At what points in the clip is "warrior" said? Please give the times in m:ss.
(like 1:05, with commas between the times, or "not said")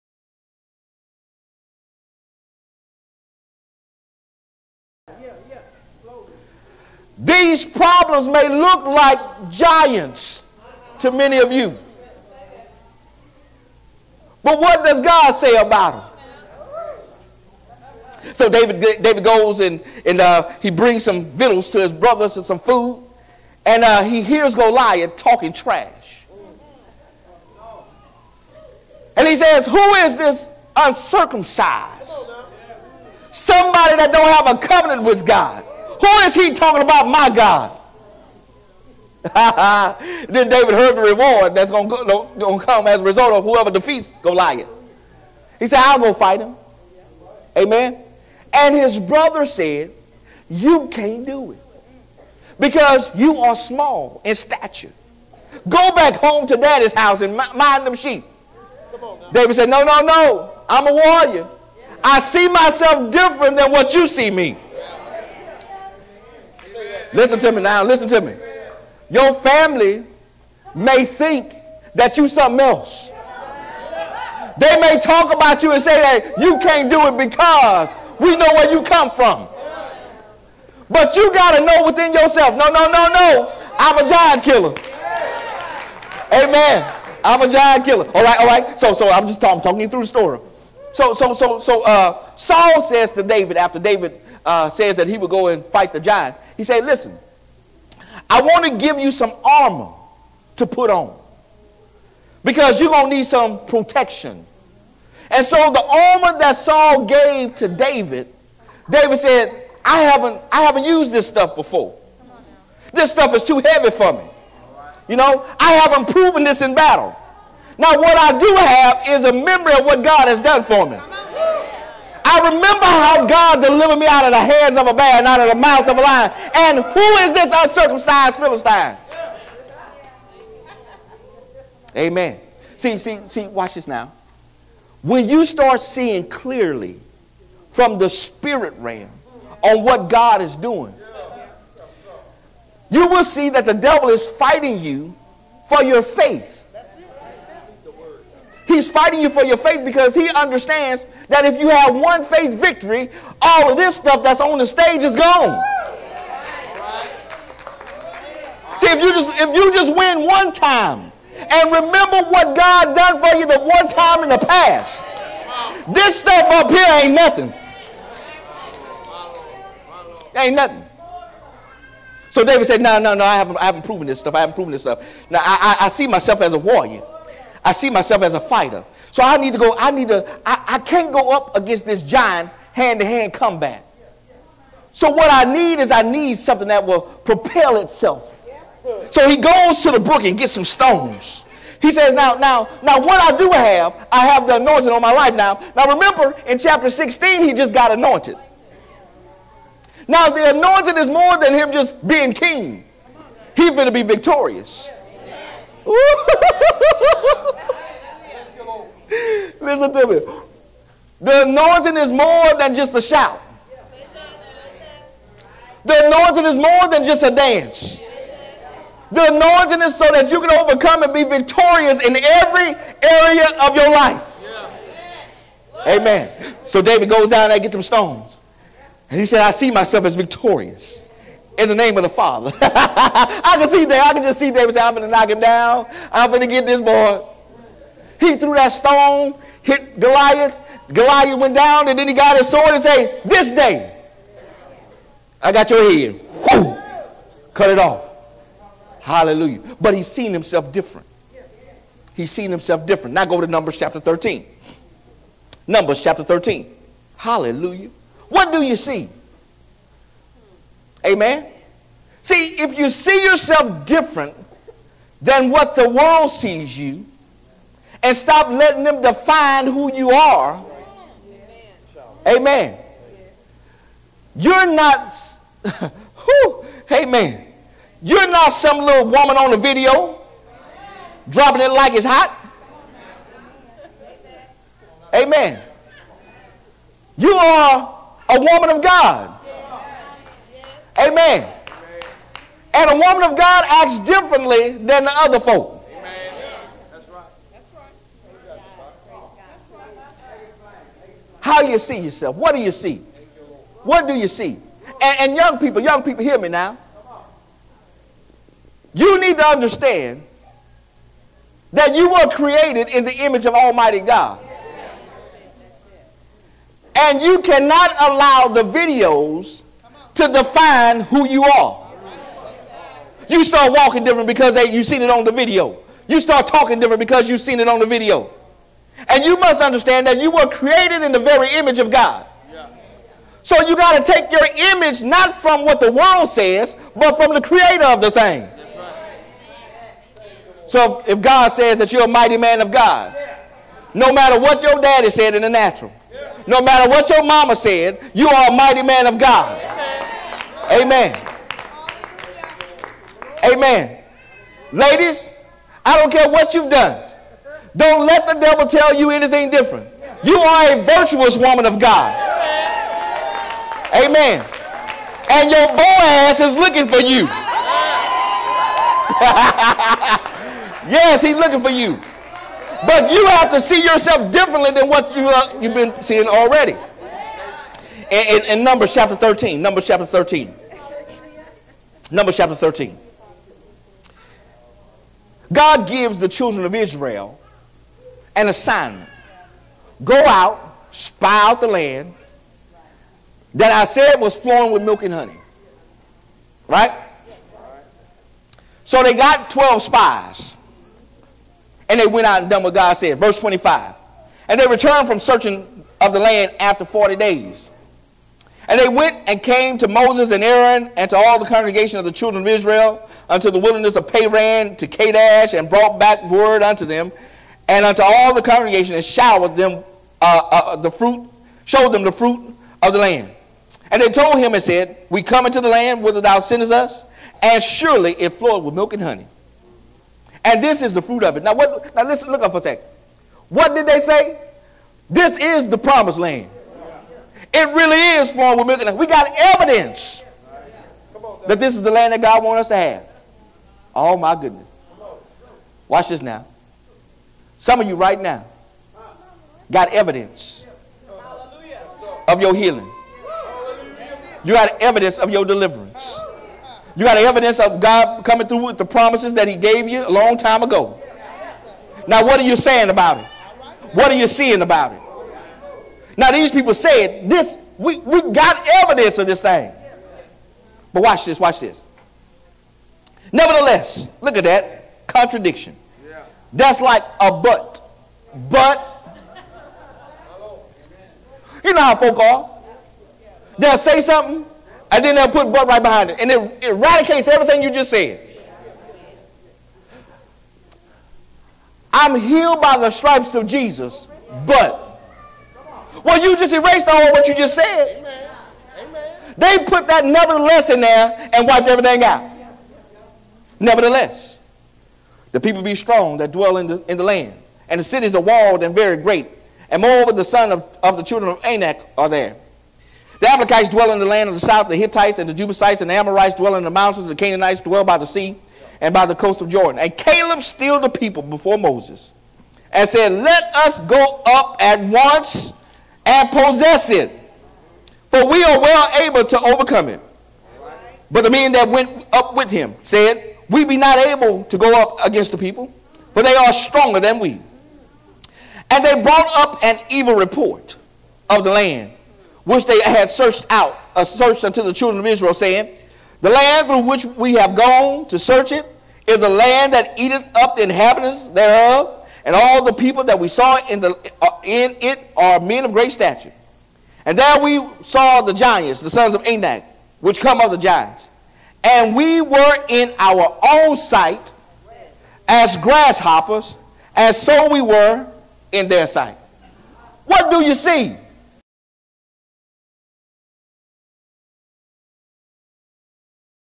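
1:00, 2:56.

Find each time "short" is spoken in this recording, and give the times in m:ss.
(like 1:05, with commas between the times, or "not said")
not said.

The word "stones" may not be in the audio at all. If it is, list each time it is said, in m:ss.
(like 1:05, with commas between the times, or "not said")
3:10, 3:47, 3:58.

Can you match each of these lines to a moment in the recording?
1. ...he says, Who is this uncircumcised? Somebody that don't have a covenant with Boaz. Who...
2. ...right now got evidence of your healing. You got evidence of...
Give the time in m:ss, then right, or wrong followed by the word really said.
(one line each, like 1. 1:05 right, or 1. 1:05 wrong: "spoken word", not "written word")
1. 0:29 wrong: "God", not "Boaz"
2. 7:27 right.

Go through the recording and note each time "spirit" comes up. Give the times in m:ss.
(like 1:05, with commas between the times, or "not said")
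2:18.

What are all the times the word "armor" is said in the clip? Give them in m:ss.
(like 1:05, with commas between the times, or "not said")
1:39, 1:45.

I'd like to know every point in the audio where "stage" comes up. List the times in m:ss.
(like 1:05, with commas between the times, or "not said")
2:34.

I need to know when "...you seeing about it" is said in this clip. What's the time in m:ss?
7:44.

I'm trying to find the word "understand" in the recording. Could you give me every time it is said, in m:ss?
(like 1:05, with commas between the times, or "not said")
2:30, 5:09, 5:29.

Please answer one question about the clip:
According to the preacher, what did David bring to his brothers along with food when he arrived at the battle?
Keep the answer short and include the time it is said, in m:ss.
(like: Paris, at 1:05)
victuals, at 0:21.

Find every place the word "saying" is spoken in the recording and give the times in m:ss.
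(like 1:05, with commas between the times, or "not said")
7:42, 9:05.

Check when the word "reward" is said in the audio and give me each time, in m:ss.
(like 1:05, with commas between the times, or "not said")
0:41.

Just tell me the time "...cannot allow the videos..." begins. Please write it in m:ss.
5:17.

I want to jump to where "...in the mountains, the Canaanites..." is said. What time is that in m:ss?
8:36.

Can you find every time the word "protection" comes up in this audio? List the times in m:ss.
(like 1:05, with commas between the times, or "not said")
1:43.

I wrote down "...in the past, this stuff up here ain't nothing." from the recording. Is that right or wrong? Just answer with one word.
right.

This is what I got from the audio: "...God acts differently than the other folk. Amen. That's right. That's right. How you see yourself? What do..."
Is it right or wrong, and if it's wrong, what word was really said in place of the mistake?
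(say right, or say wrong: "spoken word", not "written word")
right.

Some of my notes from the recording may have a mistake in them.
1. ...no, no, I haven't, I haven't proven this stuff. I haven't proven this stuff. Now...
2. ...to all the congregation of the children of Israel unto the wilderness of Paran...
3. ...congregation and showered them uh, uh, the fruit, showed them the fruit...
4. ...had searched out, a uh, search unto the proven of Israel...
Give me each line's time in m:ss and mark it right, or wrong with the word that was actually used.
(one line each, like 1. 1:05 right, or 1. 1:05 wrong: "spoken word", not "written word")
1. 2:52 right
2. 6:51 right
3. 6:58 right
4. 9:02 wrong: "children", not "proven".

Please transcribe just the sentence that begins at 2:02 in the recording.
I remember how God delivered me out of the hands of a bear and out of the mouth of a lion.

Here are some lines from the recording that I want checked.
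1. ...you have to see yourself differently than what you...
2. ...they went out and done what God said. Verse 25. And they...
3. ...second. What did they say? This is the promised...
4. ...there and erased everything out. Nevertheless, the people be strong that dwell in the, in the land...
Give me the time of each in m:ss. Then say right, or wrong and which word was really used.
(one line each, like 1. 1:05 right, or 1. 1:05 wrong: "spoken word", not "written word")
1. 6:13 right
2. 6:41 right
3. 7:12 right
4. 8:20 wrong: "wiped", not "erased".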